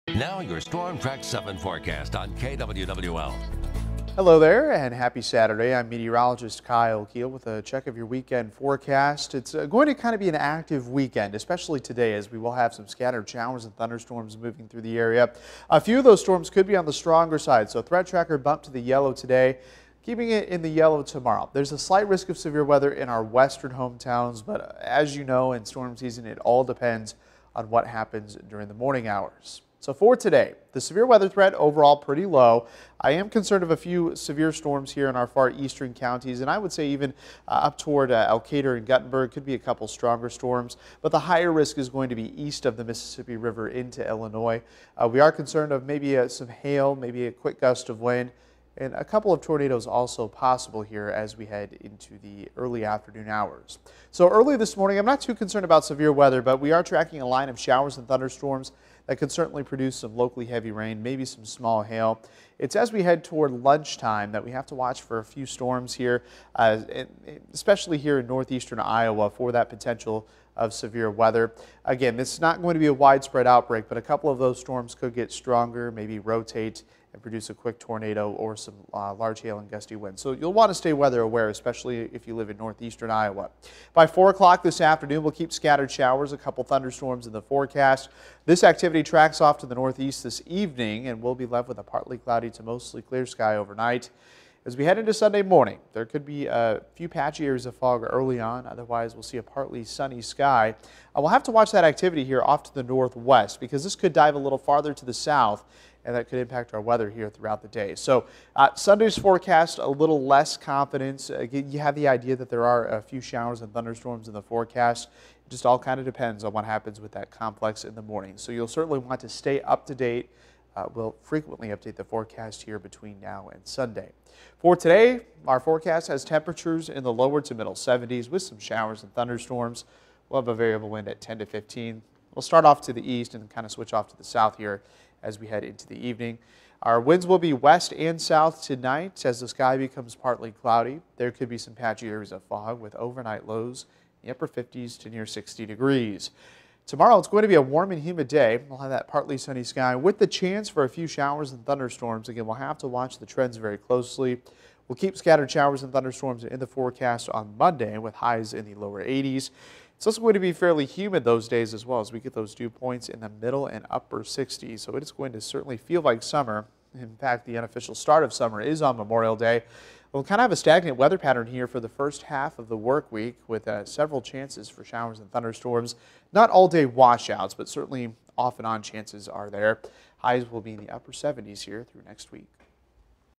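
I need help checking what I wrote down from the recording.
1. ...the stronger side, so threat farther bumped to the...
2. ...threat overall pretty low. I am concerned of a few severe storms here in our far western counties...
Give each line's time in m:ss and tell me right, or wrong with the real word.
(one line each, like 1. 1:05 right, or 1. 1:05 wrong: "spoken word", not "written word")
1. 0:16 wrong: "tracker", not "farther"
2. 0:31 wrong: "eastern", not "western".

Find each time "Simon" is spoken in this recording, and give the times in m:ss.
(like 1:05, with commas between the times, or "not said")
not said.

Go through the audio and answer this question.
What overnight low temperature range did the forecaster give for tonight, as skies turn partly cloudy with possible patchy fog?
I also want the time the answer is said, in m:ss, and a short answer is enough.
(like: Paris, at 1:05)
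Upper 50s to near 60 degrees, at 2:24.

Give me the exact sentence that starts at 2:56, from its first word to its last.
Not all day washouts, but certainly off and on chances are there.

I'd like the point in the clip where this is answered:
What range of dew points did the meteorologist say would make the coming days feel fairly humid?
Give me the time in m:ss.
2:43.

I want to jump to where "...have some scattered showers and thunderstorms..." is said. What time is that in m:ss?
0:12.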